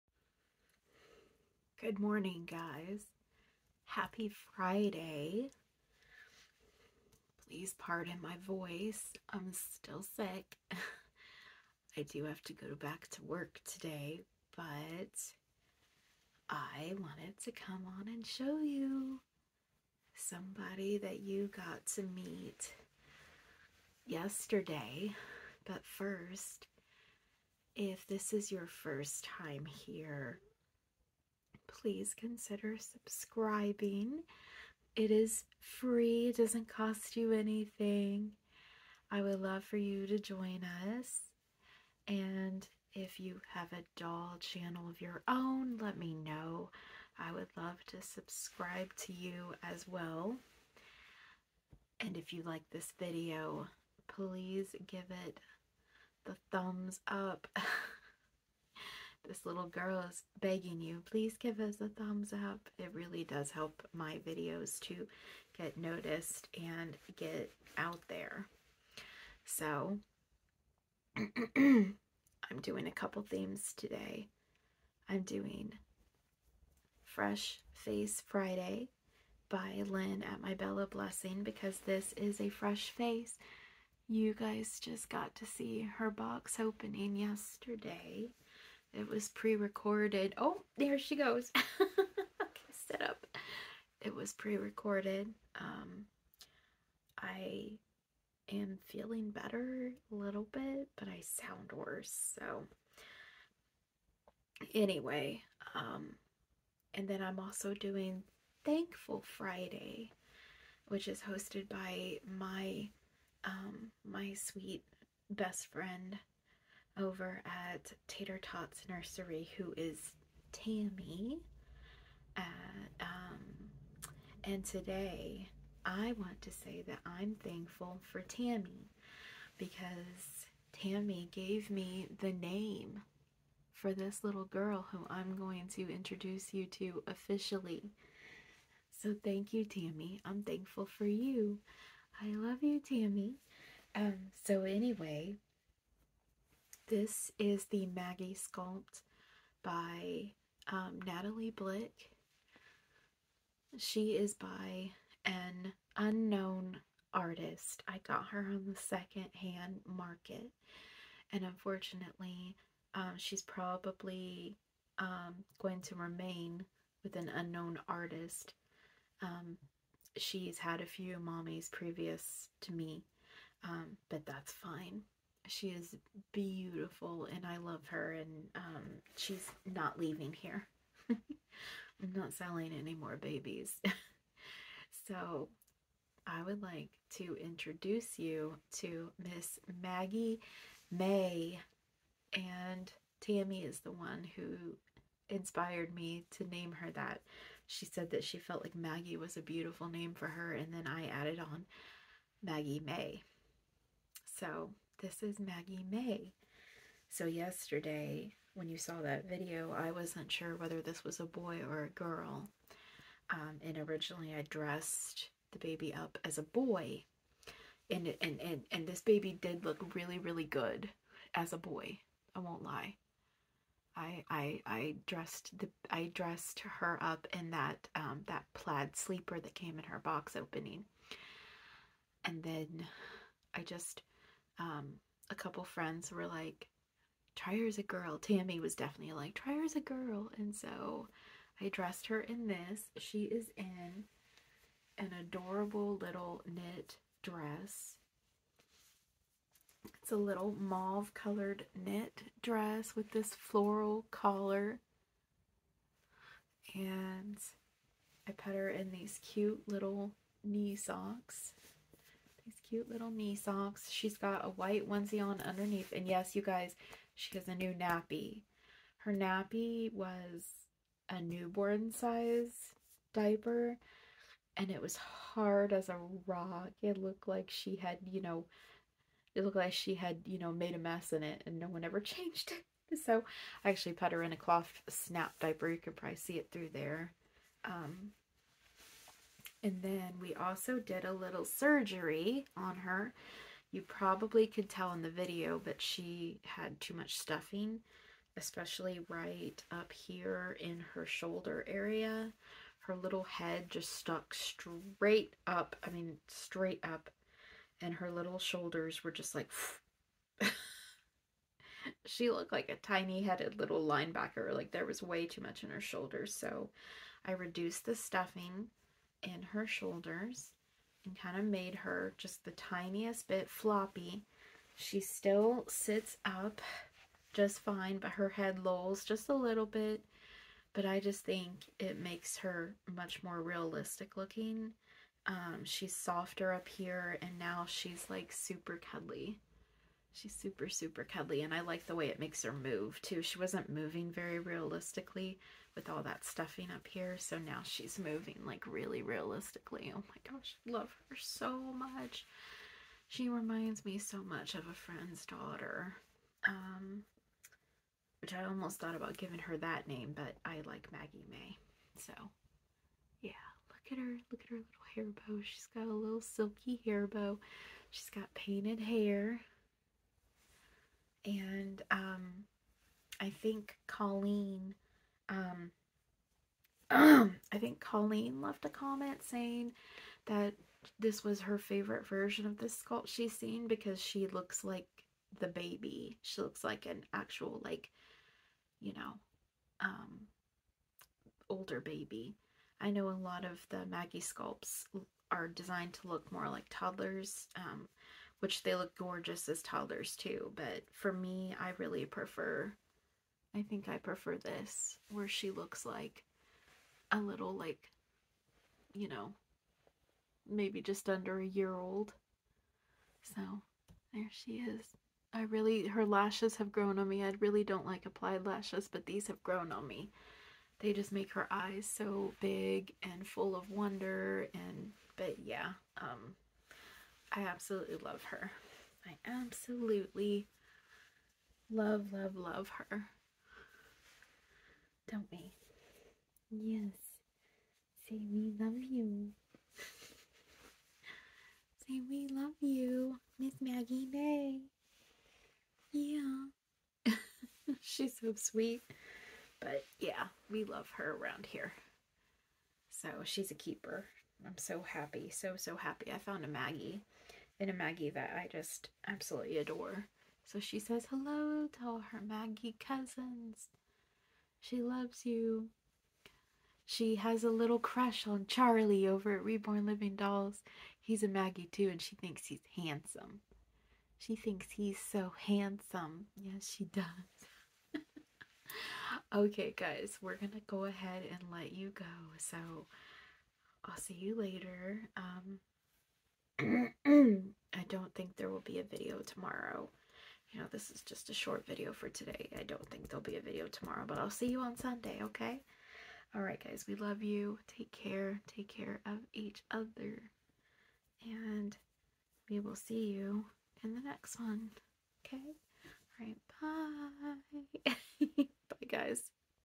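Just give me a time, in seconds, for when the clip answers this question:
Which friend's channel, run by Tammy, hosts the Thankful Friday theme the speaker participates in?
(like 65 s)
118 s.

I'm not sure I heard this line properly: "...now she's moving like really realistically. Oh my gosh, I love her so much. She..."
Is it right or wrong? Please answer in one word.
right.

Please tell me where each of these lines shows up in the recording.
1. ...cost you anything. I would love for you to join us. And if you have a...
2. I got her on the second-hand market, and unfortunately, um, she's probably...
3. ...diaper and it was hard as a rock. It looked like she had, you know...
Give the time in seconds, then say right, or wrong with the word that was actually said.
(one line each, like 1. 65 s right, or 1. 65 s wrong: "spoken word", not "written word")
1. 36 s right
2. 157 s right
3. 273 s right.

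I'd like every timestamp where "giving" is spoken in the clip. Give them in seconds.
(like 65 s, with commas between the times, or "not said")
359 s.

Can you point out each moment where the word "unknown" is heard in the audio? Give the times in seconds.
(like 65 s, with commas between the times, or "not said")
155 s, 167 s.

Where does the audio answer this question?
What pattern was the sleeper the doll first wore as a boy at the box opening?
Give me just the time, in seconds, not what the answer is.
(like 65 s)
228 s.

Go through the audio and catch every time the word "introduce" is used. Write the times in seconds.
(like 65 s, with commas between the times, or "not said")
135 s, 187 s.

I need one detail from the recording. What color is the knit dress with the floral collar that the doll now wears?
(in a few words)
Mauve.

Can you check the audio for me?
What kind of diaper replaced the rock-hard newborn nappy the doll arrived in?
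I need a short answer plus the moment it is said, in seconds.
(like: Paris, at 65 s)
Cloth snap diaper, at 284 s.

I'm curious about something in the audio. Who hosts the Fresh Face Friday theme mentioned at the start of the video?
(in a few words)
Lynn.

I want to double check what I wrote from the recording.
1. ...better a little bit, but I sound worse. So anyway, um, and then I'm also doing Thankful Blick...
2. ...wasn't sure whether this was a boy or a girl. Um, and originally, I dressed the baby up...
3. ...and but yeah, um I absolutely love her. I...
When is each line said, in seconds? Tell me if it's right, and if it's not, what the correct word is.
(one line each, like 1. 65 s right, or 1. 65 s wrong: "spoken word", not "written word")
1. 99 s wrong: "Friday", not "Blick"
2. 209 s right
3. 424 s right.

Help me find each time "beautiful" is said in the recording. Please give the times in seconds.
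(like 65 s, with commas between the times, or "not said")
176 s, 199 s.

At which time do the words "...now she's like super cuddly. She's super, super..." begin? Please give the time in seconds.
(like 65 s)
337 s.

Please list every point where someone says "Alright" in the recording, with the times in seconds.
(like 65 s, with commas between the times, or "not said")
496 s, 506 s.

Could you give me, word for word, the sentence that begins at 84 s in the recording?
You guys just got to see her box opening yesterday.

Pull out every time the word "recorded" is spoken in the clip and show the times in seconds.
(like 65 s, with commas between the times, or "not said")
89 s, 94 s.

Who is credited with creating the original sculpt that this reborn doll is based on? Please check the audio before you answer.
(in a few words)
Natali Blick.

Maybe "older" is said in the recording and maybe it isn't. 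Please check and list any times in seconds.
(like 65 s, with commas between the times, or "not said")
391 s.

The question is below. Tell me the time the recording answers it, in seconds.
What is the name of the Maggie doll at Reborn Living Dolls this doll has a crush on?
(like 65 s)
468 s.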